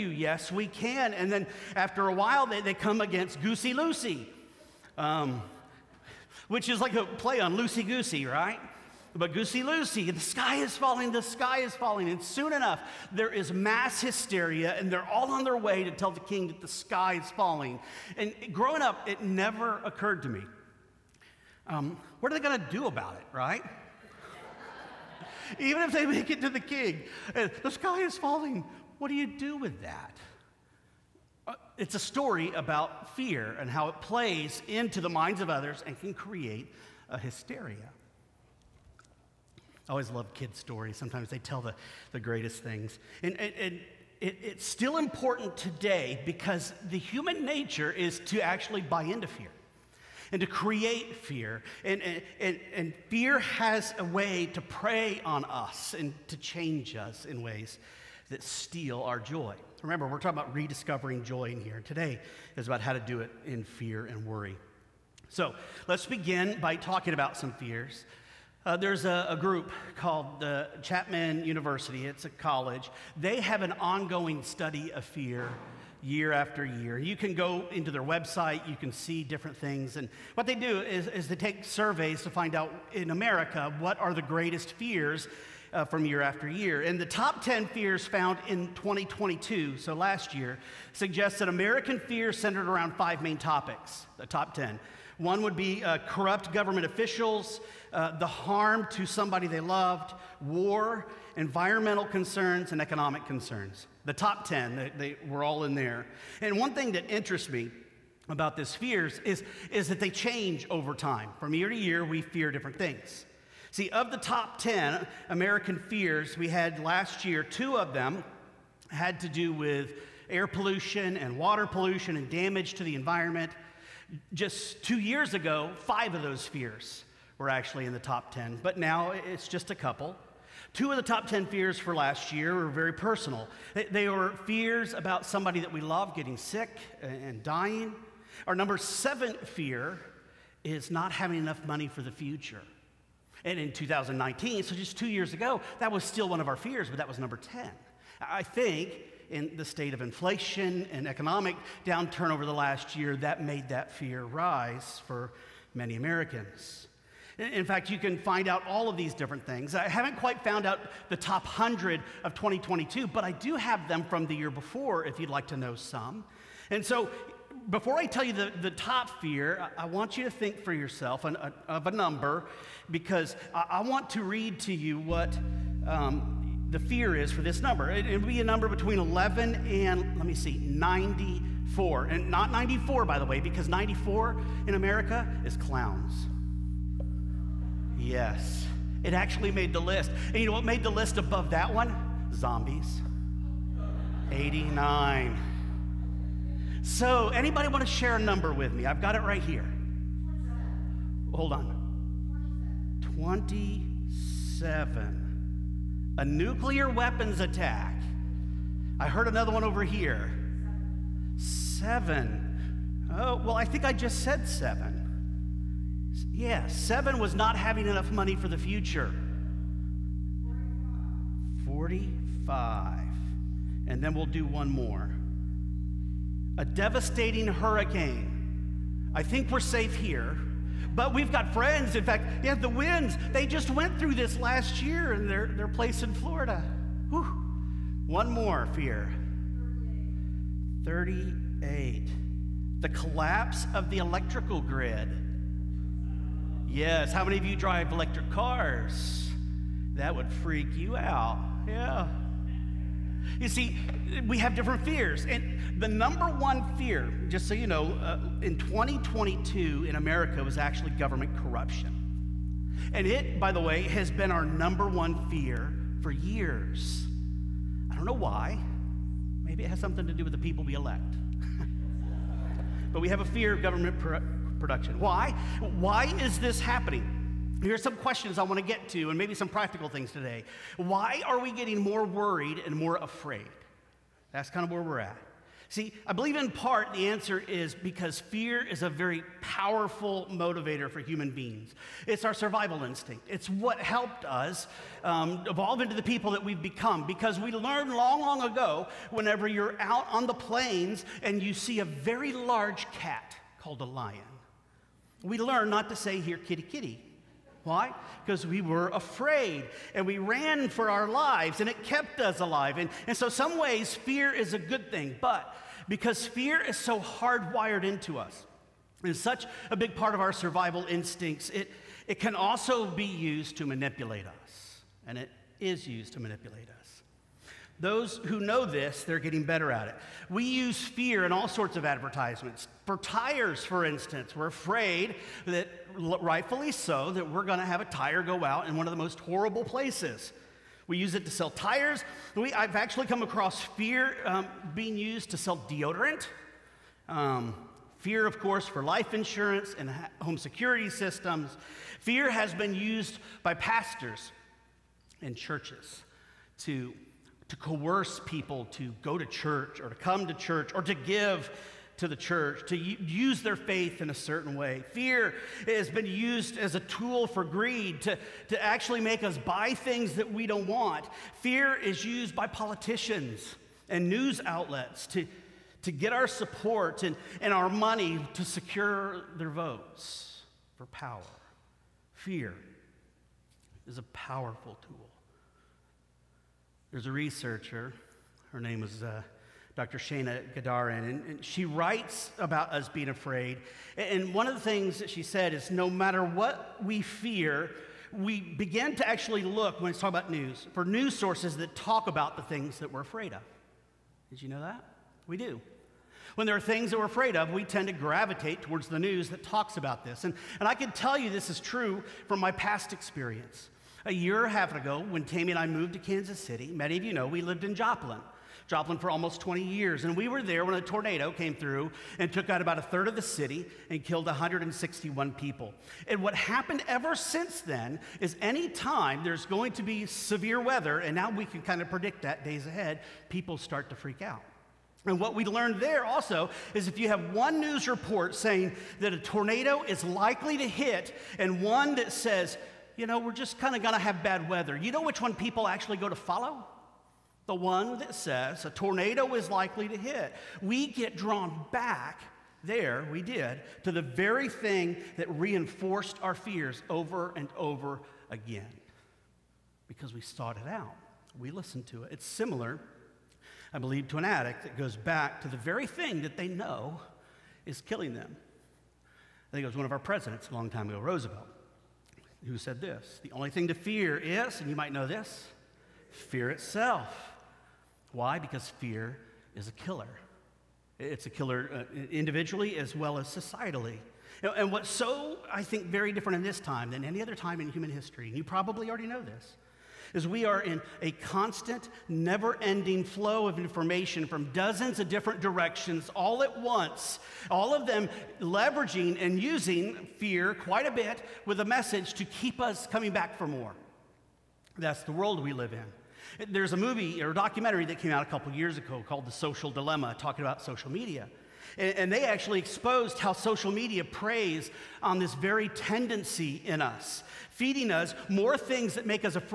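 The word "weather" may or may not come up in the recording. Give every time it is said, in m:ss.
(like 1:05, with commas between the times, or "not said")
7:10, 7:24.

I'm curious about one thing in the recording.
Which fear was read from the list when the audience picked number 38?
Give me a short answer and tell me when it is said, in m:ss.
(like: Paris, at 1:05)
Collapse of the electrical grid, at 4:02.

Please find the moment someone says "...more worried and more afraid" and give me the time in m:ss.
4:41.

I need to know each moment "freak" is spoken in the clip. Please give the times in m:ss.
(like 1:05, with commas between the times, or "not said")
4:10, 7:13.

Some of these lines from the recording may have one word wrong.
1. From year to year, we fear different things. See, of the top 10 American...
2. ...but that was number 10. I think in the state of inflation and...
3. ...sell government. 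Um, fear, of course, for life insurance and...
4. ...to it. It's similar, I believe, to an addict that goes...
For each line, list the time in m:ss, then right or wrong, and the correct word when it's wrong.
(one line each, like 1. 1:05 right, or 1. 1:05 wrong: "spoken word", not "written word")
1. 1:51 right
2. 2:26 right
3. 5:45 wrong: "deodorant", not "government"
4. 7:41 right.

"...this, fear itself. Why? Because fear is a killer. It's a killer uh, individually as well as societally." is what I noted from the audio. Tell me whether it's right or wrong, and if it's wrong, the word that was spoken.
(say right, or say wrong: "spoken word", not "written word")
right.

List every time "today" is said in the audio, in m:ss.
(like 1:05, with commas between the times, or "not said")
0:45, 1:01, 4:40.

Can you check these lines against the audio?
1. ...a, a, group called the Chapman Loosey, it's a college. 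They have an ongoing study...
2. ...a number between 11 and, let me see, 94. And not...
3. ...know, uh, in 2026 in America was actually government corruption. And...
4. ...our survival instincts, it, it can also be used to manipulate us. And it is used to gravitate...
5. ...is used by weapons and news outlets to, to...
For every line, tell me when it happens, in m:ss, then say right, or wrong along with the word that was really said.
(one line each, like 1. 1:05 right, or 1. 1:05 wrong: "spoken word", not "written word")
1. 1:09 wrong: "University", not "Loosey"
2. 2:58 right
3. 4:17 wrong: "2022", not "2026"
4. 5:20 wrong: "manipulate", not "gravitate"
5. 6:11 wrong: "politicians", not "weapons".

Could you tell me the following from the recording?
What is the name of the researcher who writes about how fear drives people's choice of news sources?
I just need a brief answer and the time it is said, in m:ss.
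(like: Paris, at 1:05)
Dr. Shana Gadarian, at 6:29.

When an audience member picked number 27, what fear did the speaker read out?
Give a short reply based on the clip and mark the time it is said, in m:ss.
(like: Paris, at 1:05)
A nuclear weapons attack, at 3:26.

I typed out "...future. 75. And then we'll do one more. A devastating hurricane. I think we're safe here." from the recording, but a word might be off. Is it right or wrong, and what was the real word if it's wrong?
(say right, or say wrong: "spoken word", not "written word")
wrong: "45", not "75".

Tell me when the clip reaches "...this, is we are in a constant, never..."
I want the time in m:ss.
8:09.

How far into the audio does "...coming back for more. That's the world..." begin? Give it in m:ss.
8:22.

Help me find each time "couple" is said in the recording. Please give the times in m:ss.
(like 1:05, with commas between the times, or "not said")
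2:09, 8:28.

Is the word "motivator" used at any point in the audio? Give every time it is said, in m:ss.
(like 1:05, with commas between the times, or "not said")
4:50.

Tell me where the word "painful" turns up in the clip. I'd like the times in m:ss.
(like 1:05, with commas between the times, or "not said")
not said.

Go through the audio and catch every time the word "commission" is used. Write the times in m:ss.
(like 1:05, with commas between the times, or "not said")
not said.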